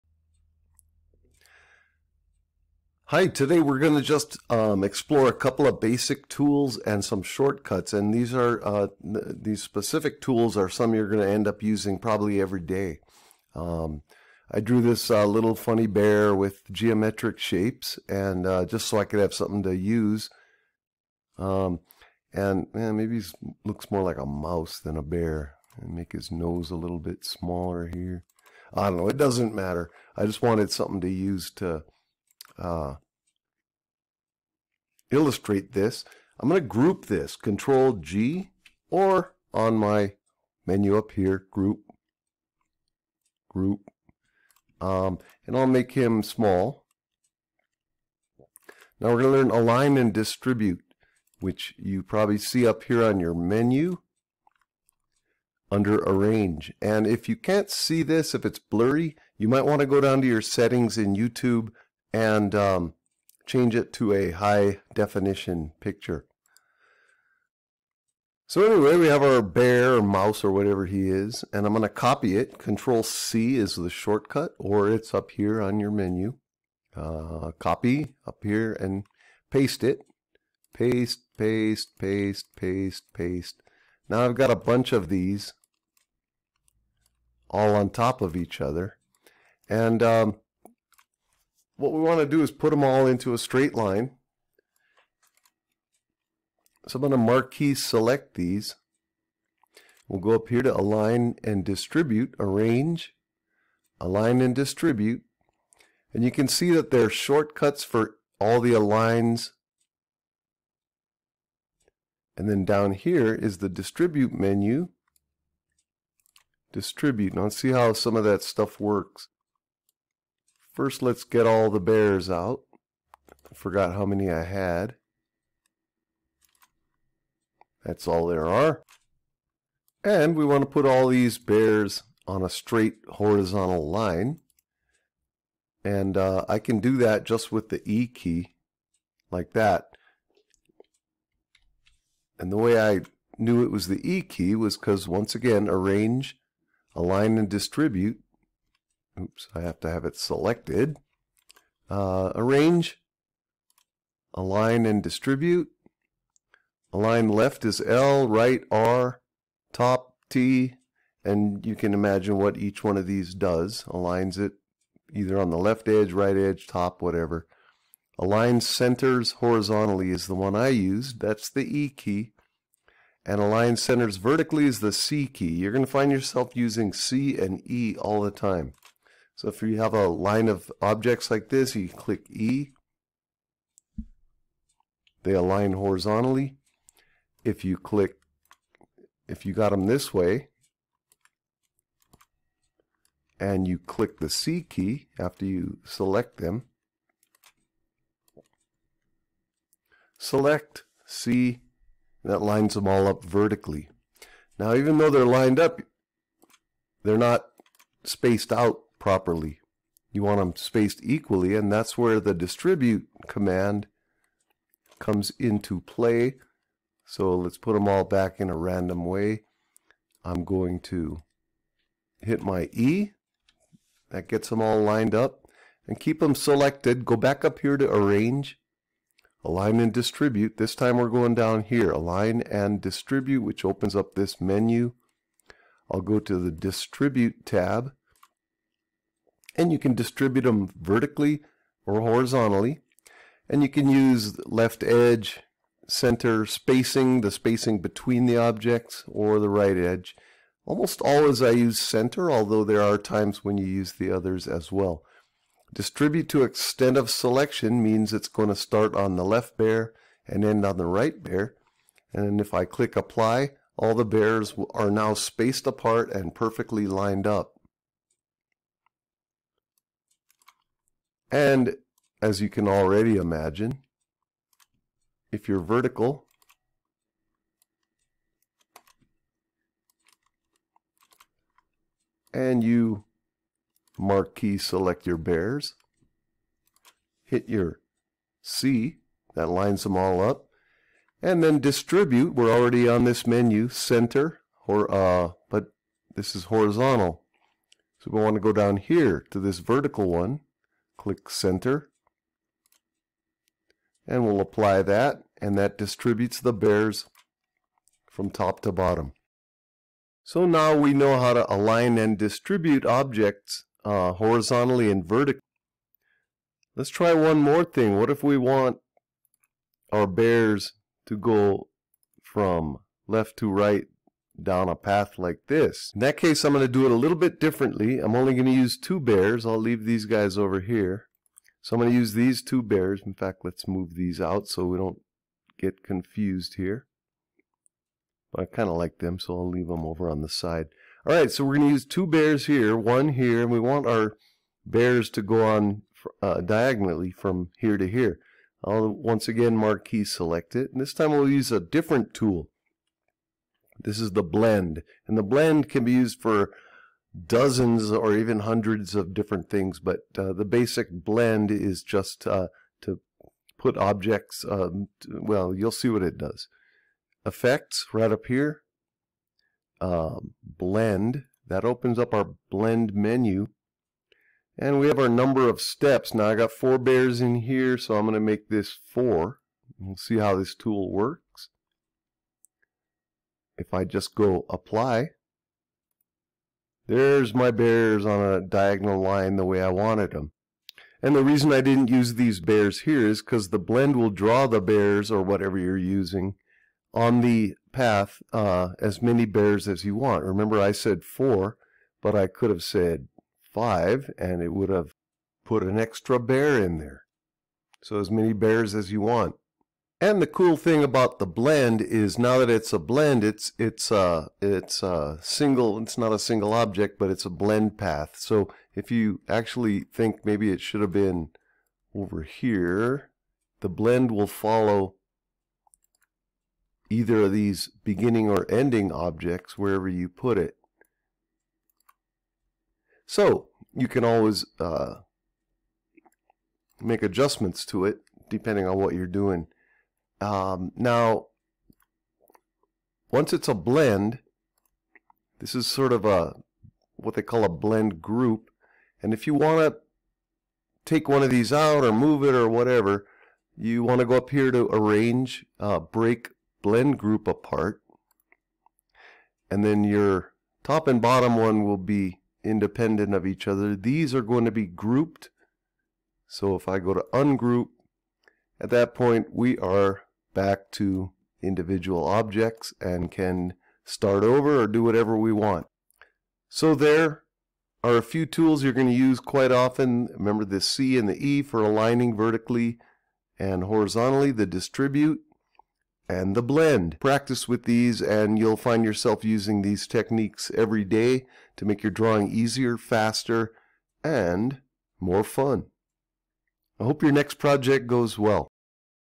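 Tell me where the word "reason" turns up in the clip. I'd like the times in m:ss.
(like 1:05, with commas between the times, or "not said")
6:31.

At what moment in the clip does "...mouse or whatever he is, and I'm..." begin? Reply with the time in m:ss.
1:10.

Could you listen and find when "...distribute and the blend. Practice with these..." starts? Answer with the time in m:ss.
8:04.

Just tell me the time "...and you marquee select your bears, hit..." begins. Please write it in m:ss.
4:42.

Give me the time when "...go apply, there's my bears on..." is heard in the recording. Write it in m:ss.
6:24.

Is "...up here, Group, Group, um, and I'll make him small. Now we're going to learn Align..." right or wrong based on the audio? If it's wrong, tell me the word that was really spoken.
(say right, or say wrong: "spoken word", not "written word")
right.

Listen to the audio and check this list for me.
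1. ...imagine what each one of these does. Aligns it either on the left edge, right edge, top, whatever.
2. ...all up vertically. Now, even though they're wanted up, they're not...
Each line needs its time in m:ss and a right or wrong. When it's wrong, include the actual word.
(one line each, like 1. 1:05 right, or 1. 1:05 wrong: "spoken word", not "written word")
1. 2:41 right
2. 3:22 wrong: "lined", not "wanted".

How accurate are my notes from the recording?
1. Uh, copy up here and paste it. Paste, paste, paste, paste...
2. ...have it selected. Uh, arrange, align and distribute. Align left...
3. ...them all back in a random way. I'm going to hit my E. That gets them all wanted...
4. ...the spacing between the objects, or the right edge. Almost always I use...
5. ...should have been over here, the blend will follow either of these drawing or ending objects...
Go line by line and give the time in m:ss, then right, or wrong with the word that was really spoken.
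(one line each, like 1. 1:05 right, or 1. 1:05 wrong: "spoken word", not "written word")
1. 1:16 right
2. 2:29 right
3. 3:37 wrong: "lined", not "wanted"
4. 4:07 right
5. 7:00 wrong: "beginning", not "drawing".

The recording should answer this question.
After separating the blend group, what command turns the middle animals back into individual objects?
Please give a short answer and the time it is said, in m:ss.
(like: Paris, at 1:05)
ungroup, at 7:47.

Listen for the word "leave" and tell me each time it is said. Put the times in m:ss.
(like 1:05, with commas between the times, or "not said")
5:29, 5:39.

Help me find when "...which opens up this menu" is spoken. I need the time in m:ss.
3:53.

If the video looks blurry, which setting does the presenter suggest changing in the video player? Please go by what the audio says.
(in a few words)
high definition.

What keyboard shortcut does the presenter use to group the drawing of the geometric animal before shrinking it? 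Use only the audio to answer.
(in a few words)
Control G.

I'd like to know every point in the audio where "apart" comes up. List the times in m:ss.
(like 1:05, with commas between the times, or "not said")
4:25, 7:37.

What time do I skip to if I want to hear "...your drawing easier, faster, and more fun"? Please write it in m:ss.
8:11.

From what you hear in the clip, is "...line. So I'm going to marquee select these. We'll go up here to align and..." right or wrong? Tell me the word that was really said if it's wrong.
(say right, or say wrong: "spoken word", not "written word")
right.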